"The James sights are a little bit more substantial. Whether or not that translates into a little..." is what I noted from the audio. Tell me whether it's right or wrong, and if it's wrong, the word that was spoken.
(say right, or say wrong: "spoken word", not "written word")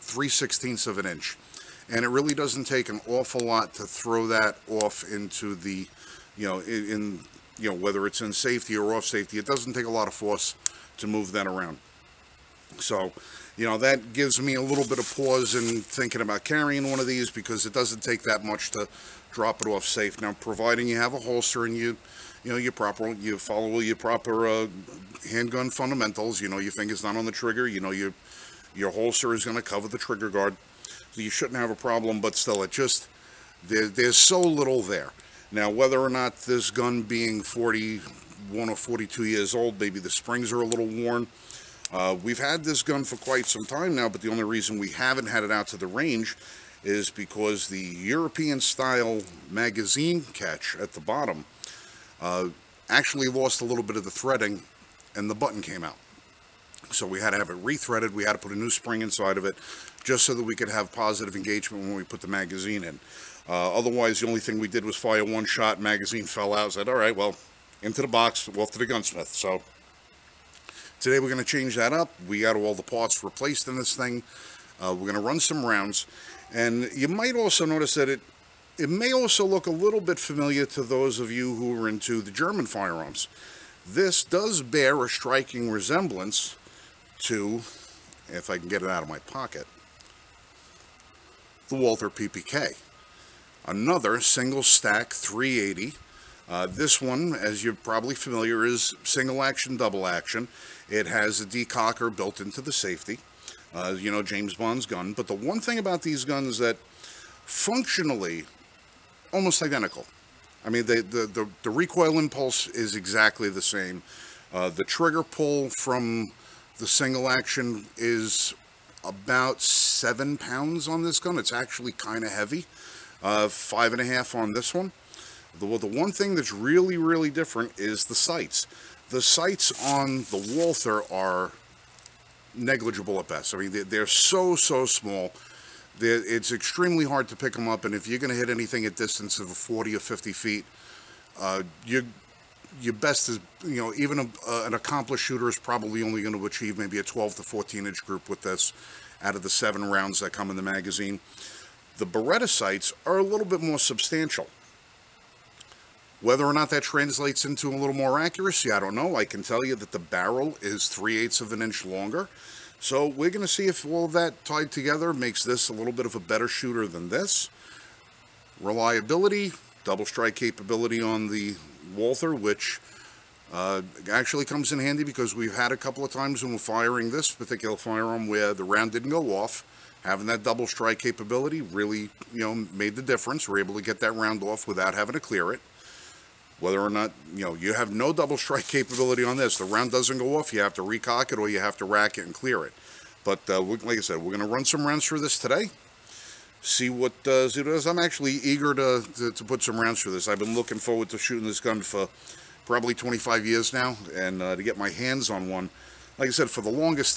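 wrong: "Beretta", not "James".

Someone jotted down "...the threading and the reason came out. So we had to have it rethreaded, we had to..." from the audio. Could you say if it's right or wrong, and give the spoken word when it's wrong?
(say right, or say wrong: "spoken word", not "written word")
wrong: "button", not "reason".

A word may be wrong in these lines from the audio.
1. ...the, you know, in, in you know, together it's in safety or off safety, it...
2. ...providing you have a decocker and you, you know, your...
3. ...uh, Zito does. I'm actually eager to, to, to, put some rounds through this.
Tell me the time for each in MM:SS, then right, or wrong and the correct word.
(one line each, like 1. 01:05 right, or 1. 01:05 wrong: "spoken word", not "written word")
1. 00:05 wrong: "whether", not "together"
2. 00:20 wrong: "holster", not "decocker"
3. 03:17 right.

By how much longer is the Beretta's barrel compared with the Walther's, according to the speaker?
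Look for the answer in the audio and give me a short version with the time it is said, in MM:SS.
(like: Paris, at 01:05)
3/8 of an inch, at 02:40.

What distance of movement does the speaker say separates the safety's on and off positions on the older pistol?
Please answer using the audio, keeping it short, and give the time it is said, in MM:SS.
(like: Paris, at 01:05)
3/16 of an inch, at 00:00.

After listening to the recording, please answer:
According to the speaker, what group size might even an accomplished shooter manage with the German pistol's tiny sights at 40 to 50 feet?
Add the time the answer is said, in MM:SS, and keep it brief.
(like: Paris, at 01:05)
12 to 14 inches, at 02:27.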